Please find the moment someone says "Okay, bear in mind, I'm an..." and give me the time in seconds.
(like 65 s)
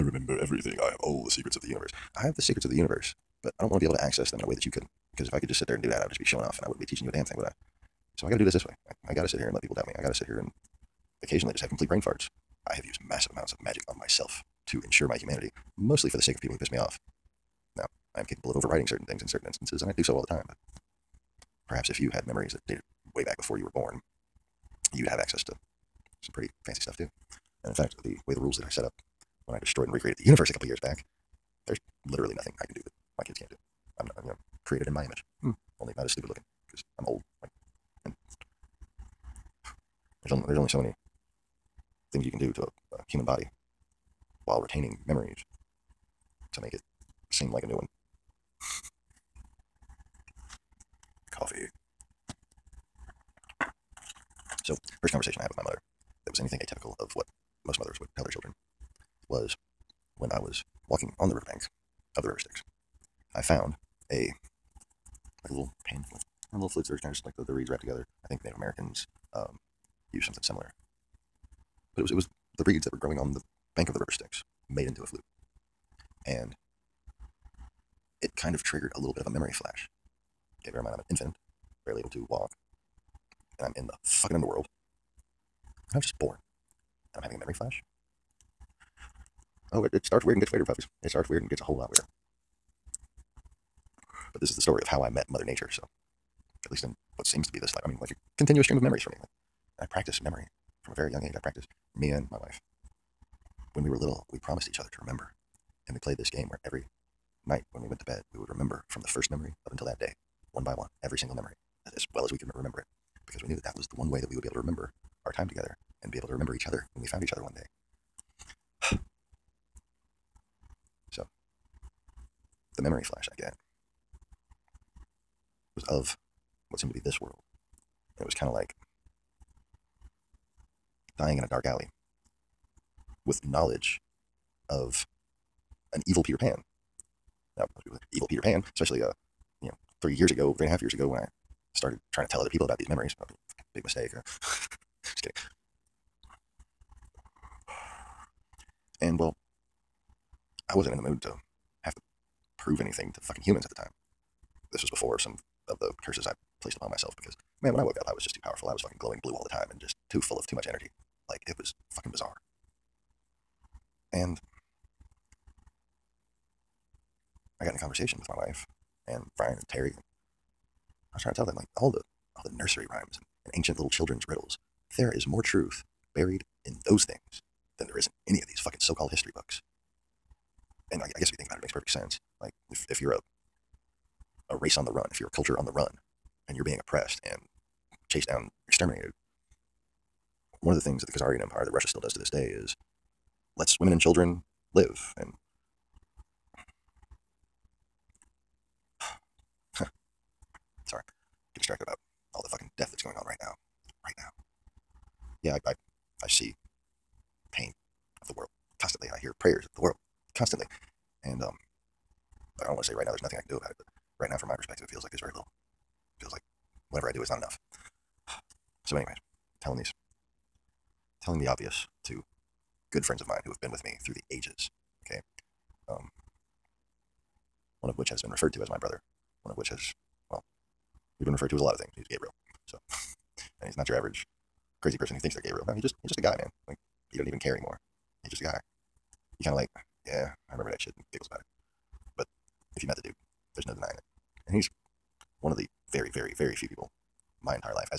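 80 s.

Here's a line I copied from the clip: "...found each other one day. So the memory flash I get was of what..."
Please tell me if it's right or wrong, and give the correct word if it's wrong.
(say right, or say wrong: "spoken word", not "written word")
right.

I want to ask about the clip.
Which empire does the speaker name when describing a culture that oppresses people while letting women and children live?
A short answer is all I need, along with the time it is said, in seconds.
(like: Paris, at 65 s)
Khazarian Empire, at 191 s.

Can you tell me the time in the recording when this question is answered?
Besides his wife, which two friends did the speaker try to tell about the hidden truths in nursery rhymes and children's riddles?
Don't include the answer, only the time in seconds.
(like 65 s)
169 s.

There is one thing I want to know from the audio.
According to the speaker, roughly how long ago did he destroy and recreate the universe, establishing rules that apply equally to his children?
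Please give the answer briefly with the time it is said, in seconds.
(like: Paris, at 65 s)
a couple years, at 30 s.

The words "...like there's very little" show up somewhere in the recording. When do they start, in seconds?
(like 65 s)
215 s.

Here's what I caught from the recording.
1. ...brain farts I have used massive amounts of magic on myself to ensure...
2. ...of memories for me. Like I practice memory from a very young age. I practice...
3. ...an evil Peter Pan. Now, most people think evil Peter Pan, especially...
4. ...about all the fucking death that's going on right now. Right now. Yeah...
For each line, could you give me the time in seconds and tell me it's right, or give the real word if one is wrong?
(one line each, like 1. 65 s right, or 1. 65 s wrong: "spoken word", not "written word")
1. 11 s right
2. 98 s right
3. 135 s right
4. 201 s right.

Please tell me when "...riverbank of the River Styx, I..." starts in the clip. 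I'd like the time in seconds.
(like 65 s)
61 s.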